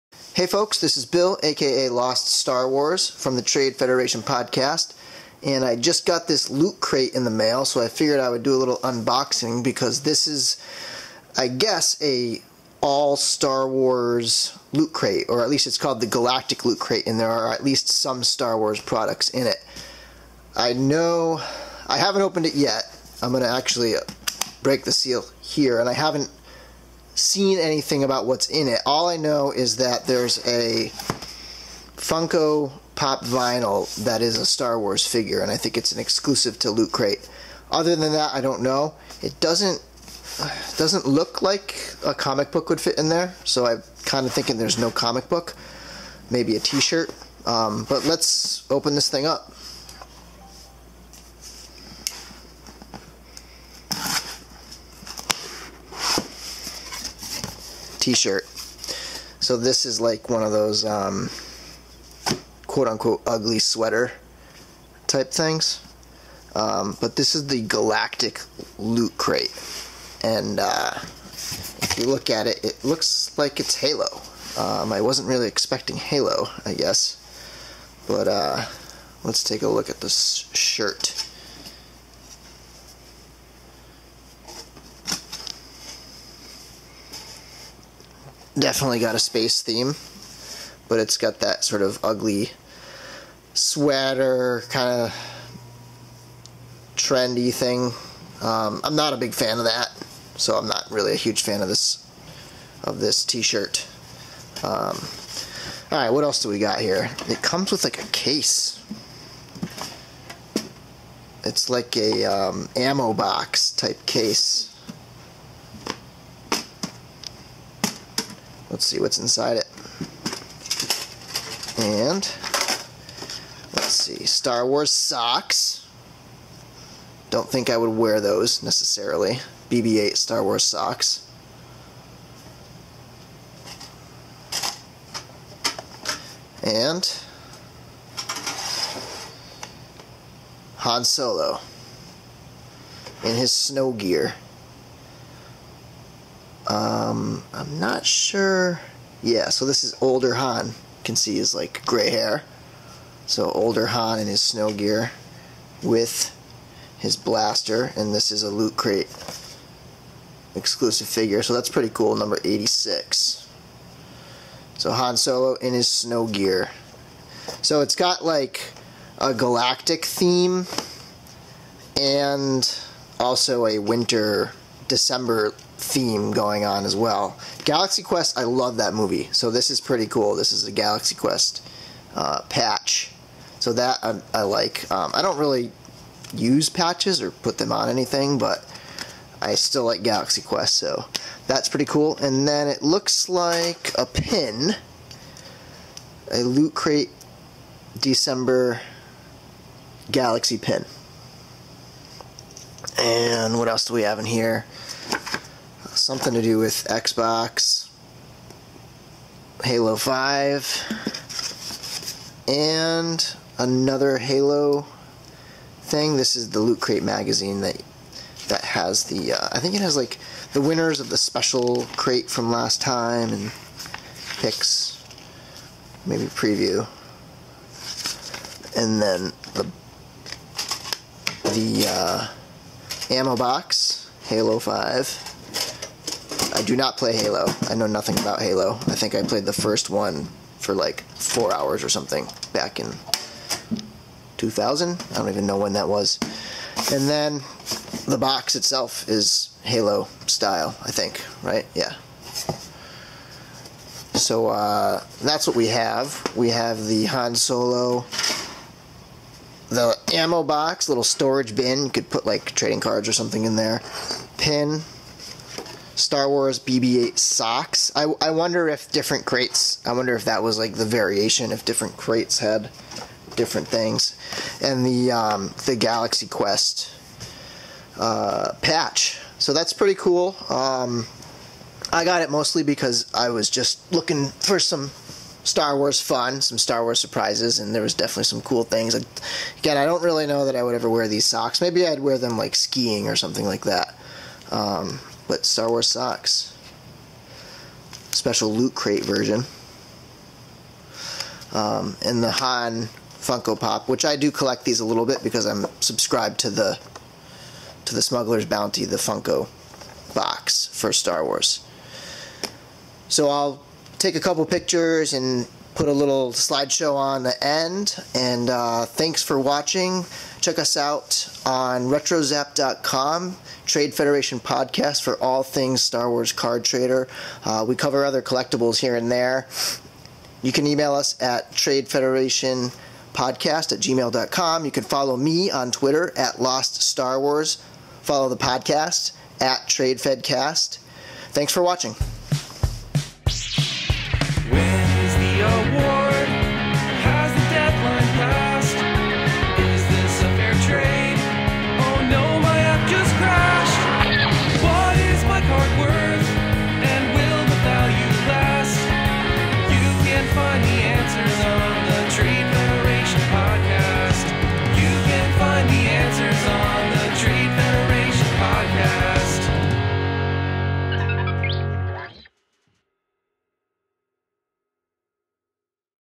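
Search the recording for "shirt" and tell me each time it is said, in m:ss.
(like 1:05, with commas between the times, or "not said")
0:46, 0:58, 1:20, 1:43.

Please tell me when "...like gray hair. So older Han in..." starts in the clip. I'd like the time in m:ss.
2:31.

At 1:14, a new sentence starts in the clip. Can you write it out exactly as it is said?
Um, I wasn't really expecting Halo, I guess.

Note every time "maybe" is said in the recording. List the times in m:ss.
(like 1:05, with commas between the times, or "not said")
0:46, 3:46, 4:51.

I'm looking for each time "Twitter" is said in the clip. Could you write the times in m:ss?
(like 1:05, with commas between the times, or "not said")
5:35.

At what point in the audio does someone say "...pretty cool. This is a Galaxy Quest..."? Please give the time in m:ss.
2:59.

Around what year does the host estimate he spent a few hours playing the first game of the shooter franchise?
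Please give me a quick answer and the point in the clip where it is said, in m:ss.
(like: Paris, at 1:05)
2000, at 4:04.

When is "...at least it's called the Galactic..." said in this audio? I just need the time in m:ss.
0:15.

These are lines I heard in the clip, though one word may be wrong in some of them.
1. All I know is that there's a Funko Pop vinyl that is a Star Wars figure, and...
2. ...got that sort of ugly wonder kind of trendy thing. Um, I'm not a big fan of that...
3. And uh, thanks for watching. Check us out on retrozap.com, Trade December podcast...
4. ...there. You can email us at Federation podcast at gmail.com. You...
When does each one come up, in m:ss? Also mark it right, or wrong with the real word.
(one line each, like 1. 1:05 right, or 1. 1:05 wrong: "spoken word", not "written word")
1. 0:28 right
2. 1:31 wrong: "sweater", not "wonder"
3. 5:18 wrong: "Federation", not "December"
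4. 5:29 right.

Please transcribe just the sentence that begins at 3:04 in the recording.
Um, I don't really use patches or put them on anything, but I still like Galaxy Quest, so that's pretty cool.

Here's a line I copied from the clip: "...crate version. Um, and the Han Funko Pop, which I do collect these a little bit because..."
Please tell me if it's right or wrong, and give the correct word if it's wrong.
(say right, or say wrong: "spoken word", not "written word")
right.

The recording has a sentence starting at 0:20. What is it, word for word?
I know I haven't opened it yet.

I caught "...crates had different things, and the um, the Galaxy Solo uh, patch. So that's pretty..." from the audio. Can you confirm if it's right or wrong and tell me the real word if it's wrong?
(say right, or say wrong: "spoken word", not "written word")
wrong: "Quest", not "Solo".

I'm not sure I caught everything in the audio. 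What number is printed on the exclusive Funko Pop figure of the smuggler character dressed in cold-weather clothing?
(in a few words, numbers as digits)
86.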